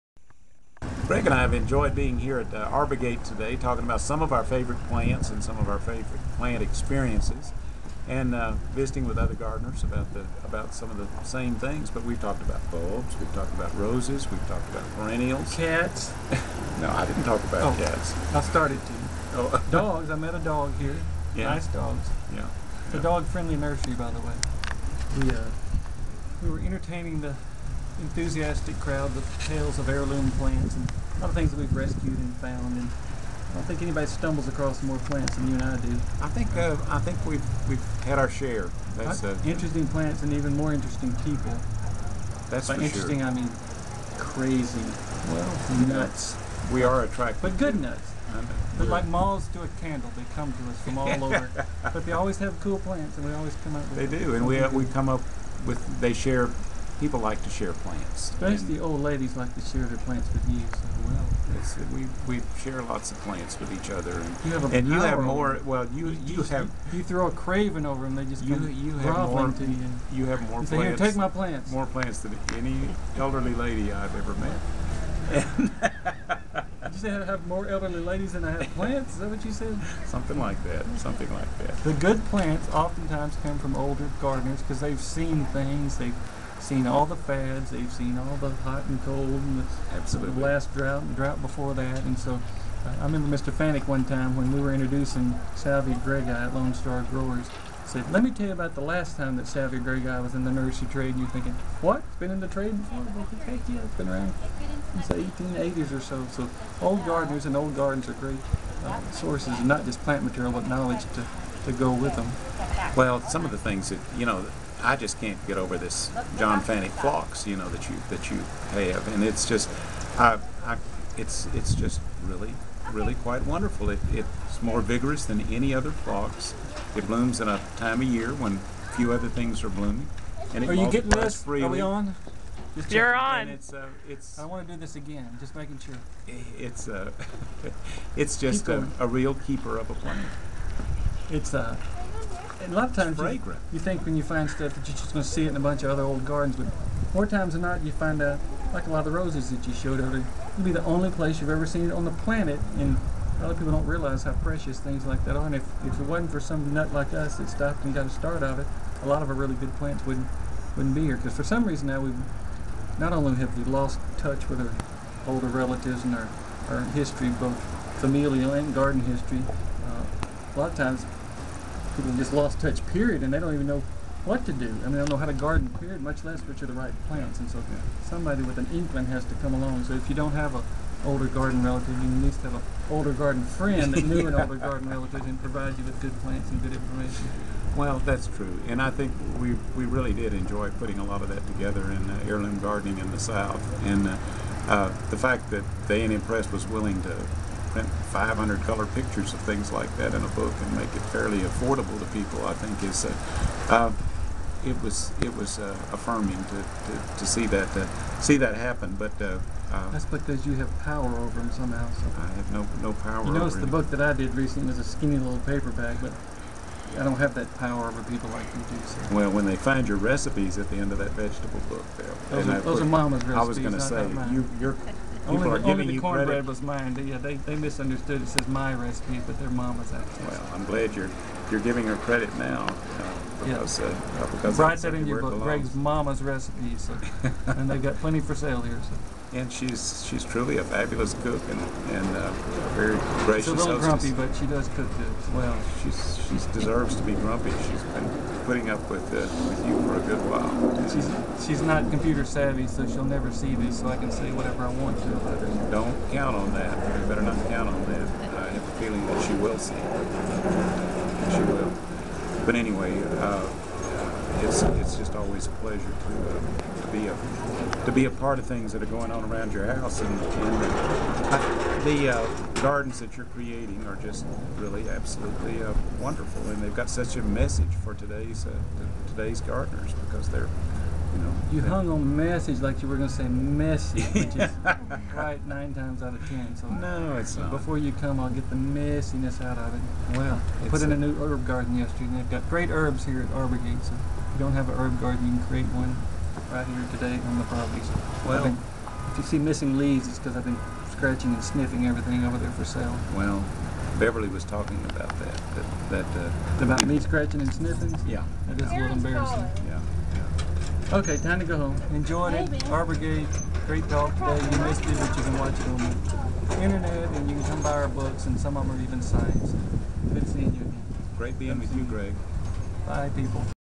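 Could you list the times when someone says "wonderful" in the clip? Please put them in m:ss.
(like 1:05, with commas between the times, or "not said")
2:03, 4:35.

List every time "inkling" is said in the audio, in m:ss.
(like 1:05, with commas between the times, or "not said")
2:58.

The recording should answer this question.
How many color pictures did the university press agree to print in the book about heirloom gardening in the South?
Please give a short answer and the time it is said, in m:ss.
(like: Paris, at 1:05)
500, at 3:17.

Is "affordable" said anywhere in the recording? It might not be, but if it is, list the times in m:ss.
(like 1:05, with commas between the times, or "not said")
3:21.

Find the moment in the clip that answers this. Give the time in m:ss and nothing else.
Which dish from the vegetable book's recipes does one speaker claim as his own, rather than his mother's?
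3:46.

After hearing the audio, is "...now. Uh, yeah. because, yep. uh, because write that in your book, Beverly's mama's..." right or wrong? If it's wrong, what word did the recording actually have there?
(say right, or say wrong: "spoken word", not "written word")
wrong: "Greg", not "Beverly".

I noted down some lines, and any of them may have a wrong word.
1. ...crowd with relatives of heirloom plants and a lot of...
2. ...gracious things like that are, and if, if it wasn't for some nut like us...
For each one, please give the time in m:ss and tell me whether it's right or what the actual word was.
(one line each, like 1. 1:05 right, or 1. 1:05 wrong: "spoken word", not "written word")
1. 0:28 wrong: "tales", not "relatives"
2. 2:34 wrong: "precious", not "gracious".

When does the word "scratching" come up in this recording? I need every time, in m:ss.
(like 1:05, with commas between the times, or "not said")
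5:00, 5:06.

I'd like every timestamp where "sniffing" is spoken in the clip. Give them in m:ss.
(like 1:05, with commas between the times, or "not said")
5:01, 5:07.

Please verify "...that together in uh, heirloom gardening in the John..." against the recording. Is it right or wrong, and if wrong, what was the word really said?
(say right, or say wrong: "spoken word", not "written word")
wrong: "South", not "John".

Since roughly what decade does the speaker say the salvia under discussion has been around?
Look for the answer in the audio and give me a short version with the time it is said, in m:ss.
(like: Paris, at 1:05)
1880s, at 1:45.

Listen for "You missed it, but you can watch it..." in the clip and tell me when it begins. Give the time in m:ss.
5:14.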